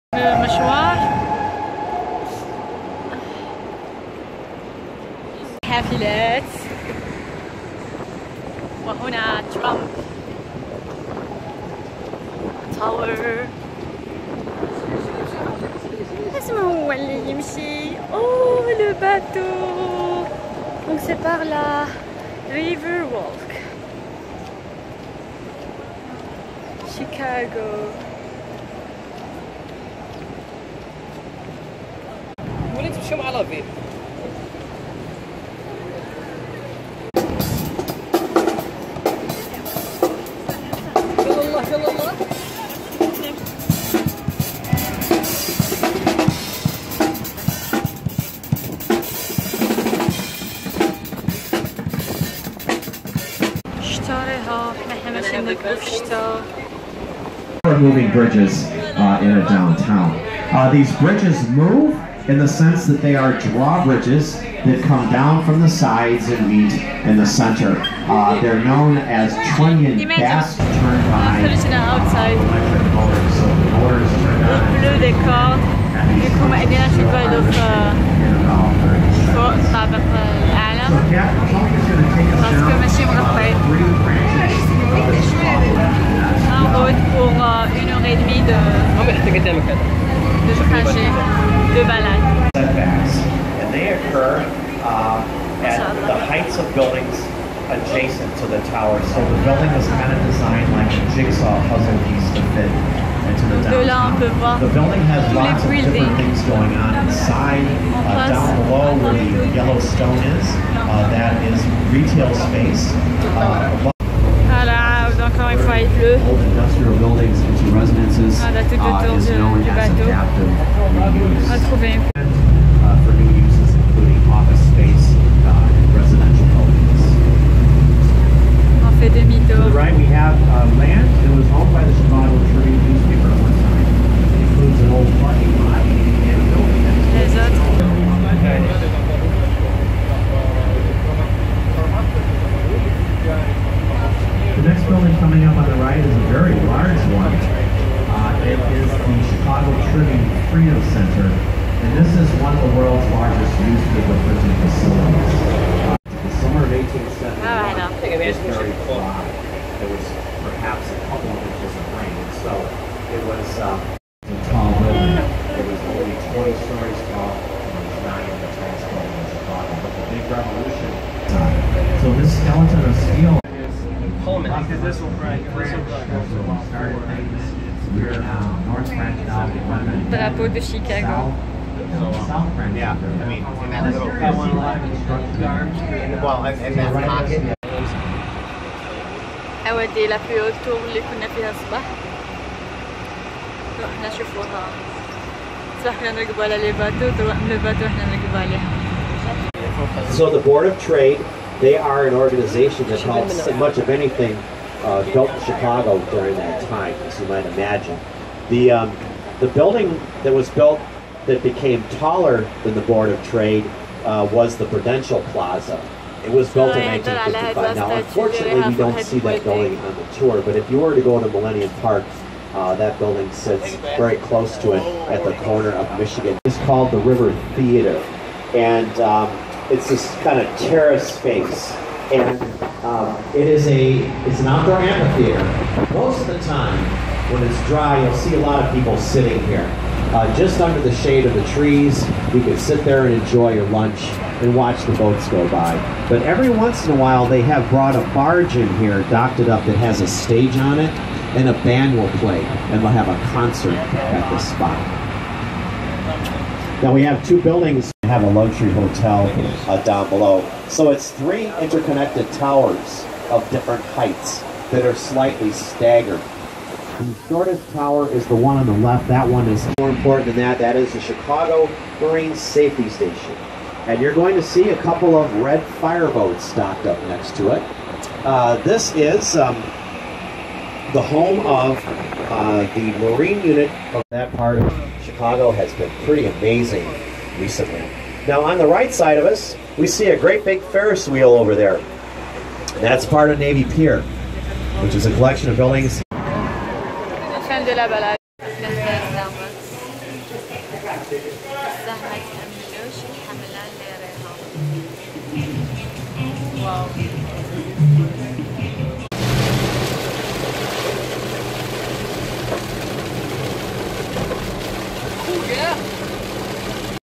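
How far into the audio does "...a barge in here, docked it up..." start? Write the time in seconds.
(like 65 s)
247 s.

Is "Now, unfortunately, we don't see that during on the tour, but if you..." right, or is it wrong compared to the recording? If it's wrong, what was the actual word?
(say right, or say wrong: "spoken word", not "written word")
wrong: "building", not "during".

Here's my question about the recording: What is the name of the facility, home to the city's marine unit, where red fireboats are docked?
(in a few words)
Chicago Marine Safety Station.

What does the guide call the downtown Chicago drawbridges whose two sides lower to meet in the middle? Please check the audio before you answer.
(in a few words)
trunnion.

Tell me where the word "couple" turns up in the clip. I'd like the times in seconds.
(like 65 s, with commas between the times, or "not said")
161 s, 274 s.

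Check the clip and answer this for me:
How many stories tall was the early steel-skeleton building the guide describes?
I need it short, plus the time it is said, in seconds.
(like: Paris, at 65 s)
20, at 166 s.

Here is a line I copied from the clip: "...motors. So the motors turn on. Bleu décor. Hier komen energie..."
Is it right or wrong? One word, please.
right.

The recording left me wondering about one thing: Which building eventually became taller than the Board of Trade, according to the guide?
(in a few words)
Prudential Plaza.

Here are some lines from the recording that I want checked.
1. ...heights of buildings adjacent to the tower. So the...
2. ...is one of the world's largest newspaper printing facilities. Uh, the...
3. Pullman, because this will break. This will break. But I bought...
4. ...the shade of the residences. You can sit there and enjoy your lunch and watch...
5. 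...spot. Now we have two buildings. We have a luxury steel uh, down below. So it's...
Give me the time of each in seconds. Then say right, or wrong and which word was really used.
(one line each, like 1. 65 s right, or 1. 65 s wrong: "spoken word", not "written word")
1. 96 s right
2. 152 s right
3. 174 s right
4. 240 s wrong: "trees", not "residences"
5. 254 s wrong: "hotel", not "steel".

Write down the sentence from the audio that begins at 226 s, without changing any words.
It's called the River Theater, and um, it's this kind of terrace space.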